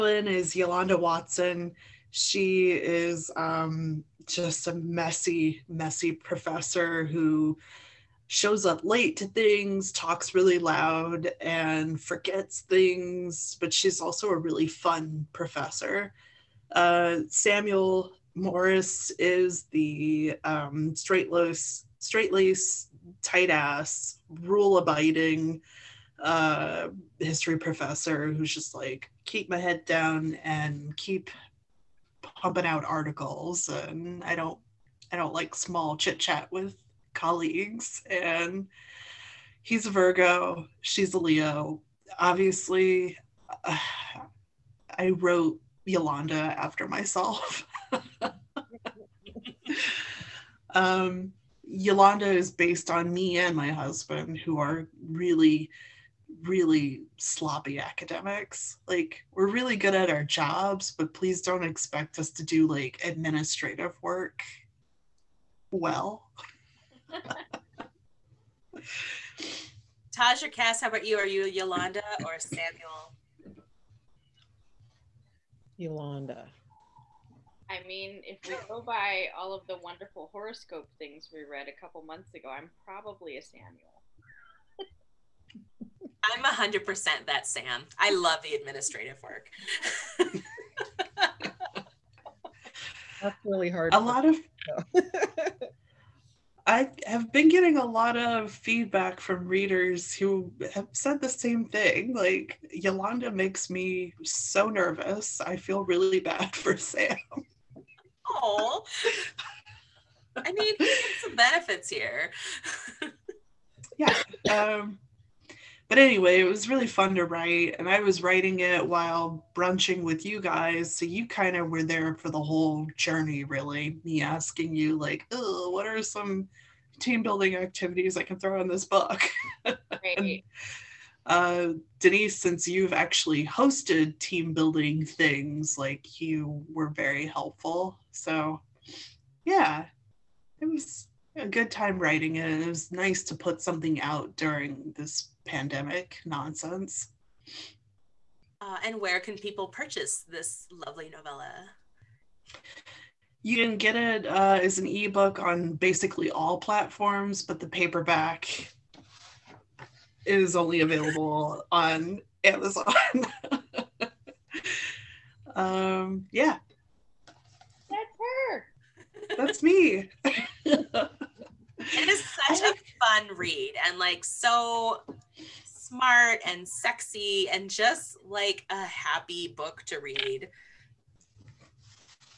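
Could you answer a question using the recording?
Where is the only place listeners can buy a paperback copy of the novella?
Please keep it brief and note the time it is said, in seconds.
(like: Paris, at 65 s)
Amazon, at 162 s.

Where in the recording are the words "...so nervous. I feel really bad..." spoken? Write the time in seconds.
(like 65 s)
104 s.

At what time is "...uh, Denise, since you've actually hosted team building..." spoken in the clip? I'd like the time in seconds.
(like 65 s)
131 s.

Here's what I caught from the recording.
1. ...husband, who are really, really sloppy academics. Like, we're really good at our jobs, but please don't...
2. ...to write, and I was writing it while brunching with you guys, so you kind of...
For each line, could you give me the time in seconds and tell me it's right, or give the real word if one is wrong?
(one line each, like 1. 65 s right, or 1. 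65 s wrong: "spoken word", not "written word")
1. 53 s right
2. 117 s right.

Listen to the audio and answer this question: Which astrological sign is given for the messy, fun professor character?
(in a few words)
Leo.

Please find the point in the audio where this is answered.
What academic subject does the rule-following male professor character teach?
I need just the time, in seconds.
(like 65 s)
27 s.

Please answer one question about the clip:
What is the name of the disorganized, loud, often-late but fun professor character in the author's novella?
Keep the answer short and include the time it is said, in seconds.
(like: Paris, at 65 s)
Yolanda Watson, at 0 s.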